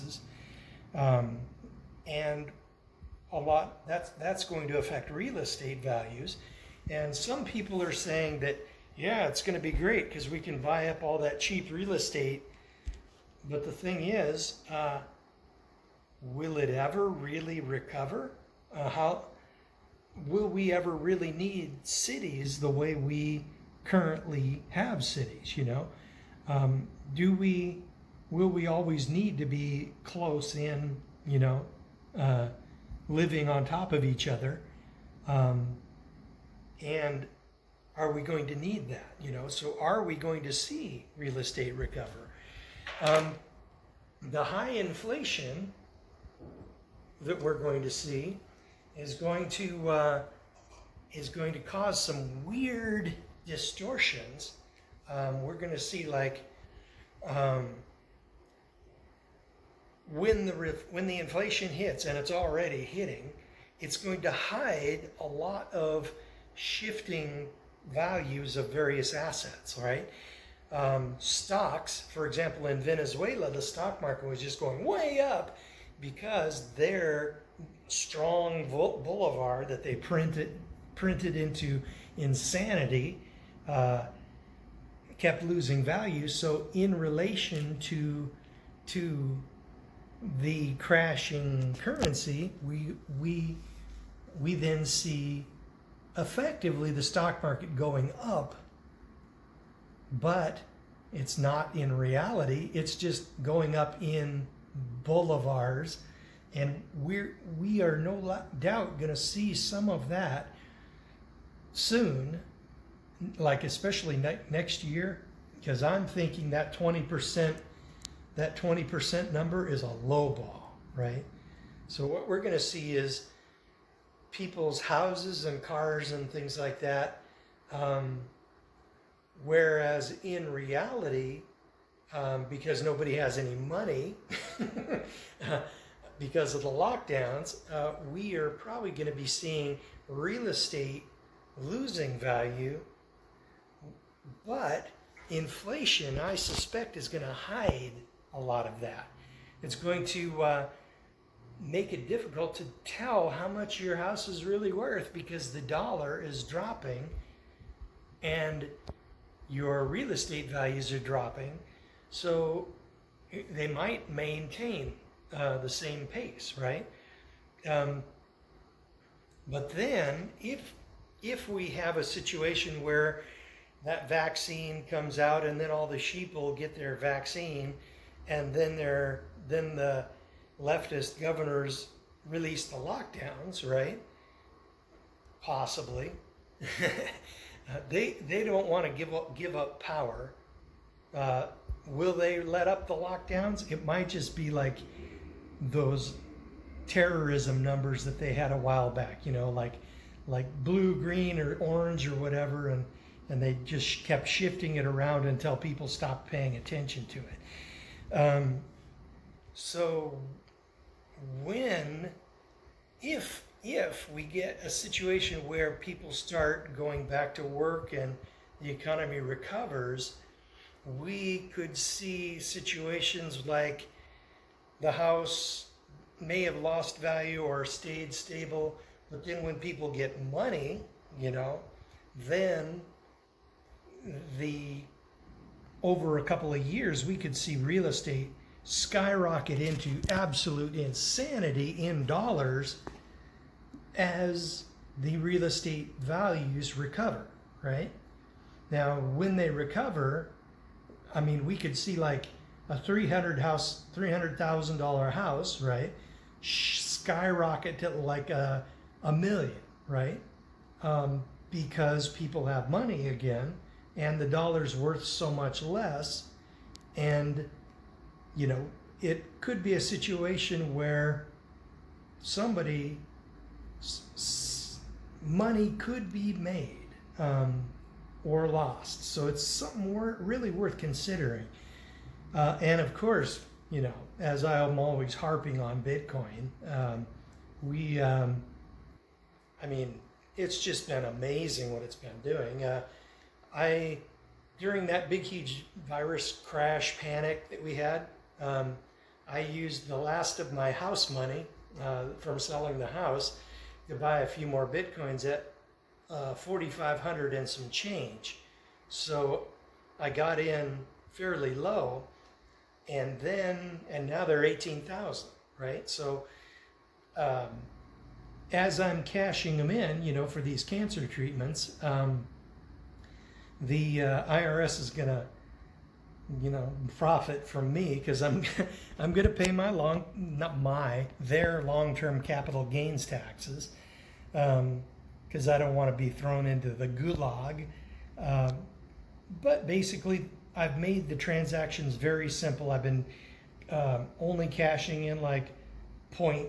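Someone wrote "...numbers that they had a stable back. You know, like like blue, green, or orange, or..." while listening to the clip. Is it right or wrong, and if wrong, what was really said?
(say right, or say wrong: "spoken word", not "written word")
wrong: "while", not "stable".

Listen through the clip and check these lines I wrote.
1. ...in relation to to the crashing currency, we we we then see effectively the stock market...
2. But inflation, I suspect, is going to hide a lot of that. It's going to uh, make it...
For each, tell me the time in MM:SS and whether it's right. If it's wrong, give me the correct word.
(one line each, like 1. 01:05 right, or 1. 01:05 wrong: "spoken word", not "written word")
1. 01:26 right
2. 02:24 right.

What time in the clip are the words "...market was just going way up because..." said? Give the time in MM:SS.
01:14.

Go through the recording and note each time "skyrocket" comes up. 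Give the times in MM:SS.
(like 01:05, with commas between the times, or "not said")
03:58, 04:16.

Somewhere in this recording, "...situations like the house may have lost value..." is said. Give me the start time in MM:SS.
03:42.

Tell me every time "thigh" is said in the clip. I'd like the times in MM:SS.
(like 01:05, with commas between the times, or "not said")
not said.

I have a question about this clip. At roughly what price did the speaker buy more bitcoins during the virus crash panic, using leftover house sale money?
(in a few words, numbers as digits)
4,500.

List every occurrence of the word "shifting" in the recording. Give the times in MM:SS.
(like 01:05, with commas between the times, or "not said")
01:06, 03:24.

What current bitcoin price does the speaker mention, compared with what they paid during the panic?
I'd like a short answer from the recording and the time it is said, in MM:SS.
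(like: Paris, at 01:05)
18,000, at 05:14.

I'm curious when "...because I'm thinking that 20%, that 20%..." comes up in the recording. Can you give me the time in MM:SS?
01:55.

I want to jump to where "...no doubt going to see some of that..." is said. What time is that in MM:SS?
01:47.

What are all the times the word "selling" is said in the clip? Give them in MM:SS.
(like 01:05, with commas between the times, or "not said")
05:02.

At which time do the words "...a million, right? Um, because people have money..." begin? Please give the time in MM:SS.
04:19.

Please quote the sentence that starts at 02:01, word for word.
So what we're going to see is people's houses and cars and things like that.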